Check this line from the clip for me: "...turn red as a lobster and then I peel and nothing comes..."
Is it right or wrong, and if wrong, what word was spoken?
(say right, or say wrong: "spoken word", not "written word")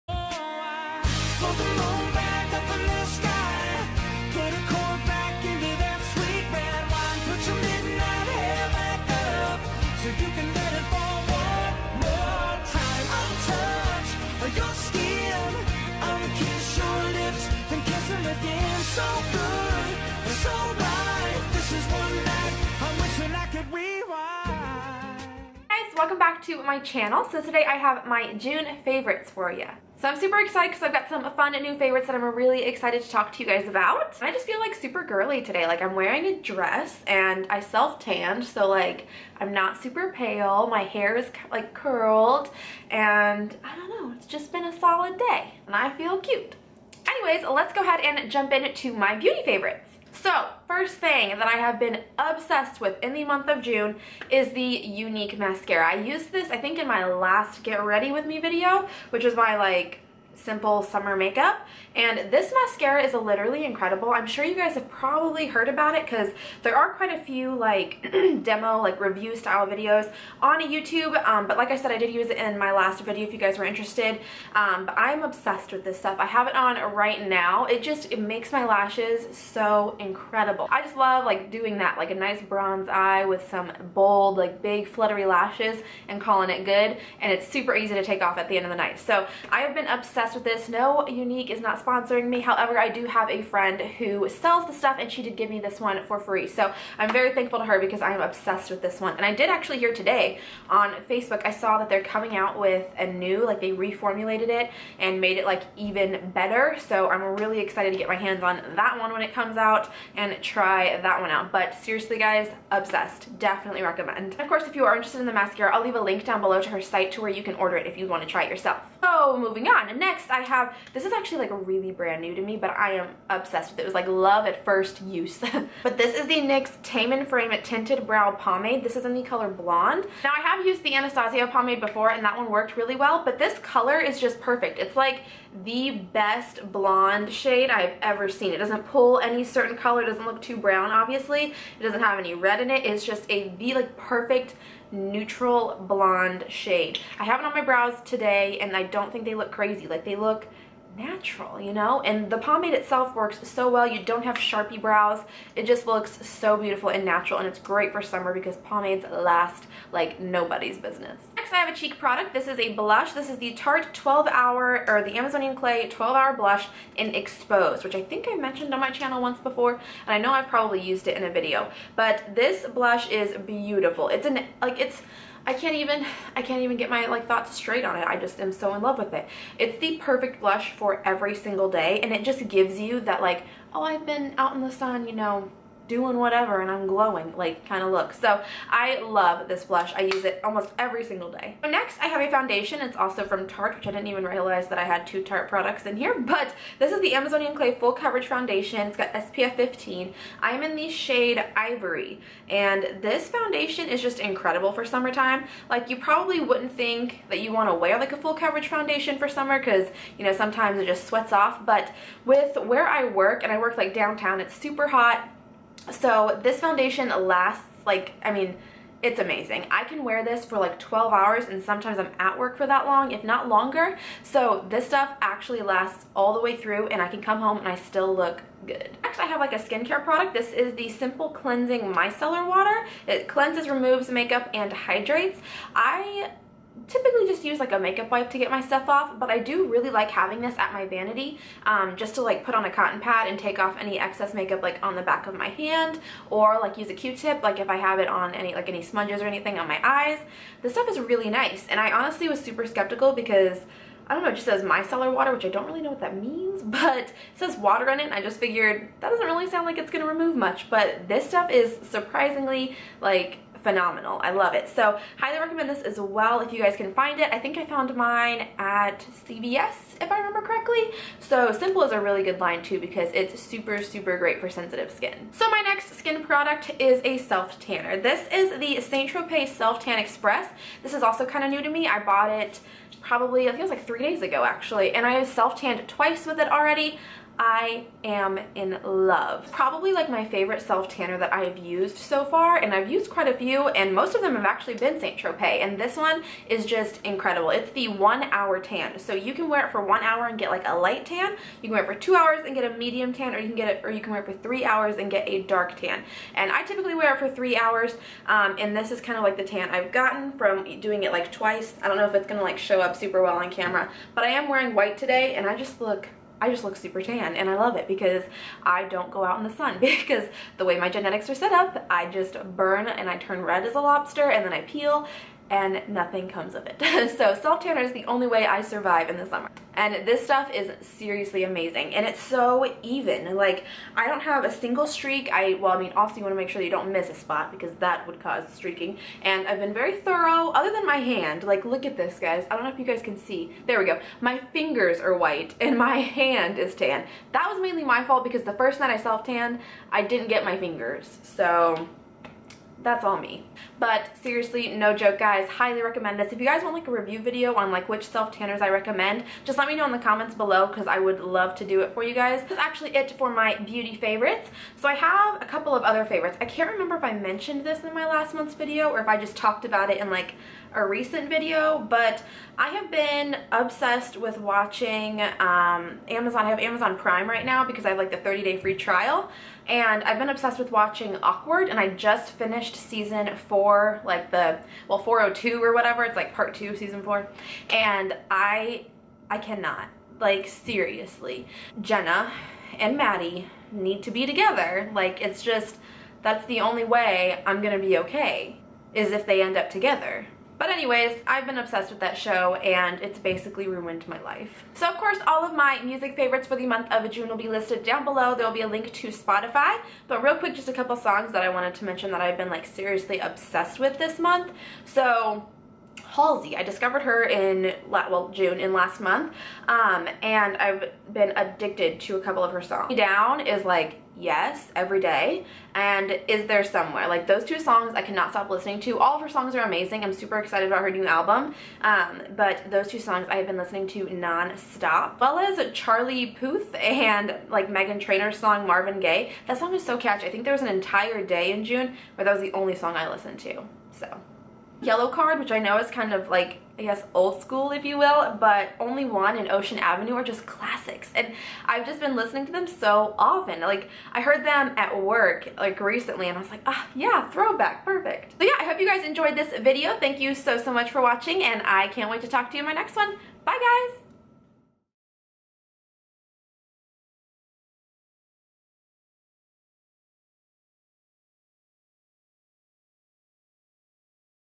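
right.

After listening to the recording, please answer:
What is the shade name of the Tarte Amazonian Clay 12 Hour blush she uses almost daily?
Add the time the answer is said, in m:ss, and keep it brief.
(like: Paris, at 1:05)
Exposed, at 2:47.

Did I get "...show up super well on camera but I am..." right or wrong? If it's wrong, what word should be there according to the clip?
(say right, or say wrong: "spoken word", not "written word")
right.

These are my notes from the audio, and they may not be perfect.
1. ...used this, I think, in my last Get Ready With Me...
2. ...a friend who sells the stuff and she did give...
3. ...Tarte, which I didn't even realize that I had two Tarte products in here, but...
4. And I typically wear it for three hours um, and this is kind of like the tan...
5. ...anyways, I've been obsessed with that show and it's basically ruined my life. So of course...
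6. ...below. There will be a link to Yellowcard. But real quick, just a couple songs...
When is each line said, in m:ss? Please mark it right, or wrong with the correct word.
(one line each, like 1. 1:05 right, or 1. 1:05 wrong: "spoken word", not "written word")
1. 0:56 right
2. 1:33 right
3. 3:13 right
4. 5:06 right
5. 6:40 right
6. 6:48 wrong: "Spotify", not "Yellowcard".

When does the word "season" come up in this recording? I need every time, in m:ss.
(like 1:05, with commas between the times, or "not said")
6:22, 6:26.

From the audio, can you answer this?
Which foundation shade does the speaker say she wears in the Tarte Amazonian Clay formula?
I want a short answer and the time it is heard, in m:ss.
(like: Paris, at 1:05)
Ivory, at 3:21.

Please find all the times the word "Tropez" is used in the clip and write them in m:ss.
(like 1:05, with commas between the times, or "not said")
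4:39, 4:55.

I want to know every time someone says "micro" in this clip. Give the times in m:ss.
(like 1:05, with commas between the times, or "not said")
not said.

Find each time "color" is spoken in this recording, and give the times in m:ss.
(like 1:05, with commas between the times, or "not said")
2:09, 2:13, 2:19.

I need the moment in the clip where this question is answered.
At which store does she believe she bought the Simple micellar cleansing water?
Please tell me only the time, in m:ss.
4:29.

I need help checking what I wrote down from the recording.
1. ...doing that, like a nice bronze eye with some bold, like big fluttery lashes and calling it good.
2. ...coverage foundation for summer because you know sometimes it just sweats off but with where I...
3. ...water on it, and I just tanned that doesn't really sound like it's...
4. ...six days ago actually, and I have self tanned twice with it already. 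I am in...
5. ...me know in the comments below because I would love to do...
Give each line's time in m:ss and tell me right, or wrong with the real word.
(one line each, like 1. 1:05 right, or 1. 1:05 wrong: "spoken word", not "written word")
1. 1:21 right
2. 3:28 right
3. 4:17 wrong: "figured", not "tanned"
4. 4:43 wrong: "three", not "six"
5. 5:59 right.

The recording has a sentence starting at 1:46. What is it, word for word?
So I'm really excited to get my hands on that one when it comes out and try that one out.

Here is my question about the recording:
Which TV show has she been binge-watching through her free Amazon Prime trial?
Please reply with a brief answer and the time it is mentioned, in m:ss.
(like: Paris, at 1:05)
Awkward, at 6:21.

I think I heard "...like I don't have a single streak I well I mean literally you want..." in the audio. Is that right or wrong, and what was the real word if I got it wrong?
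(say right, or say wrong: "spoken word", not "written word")
wrong: "obviously", not "literally".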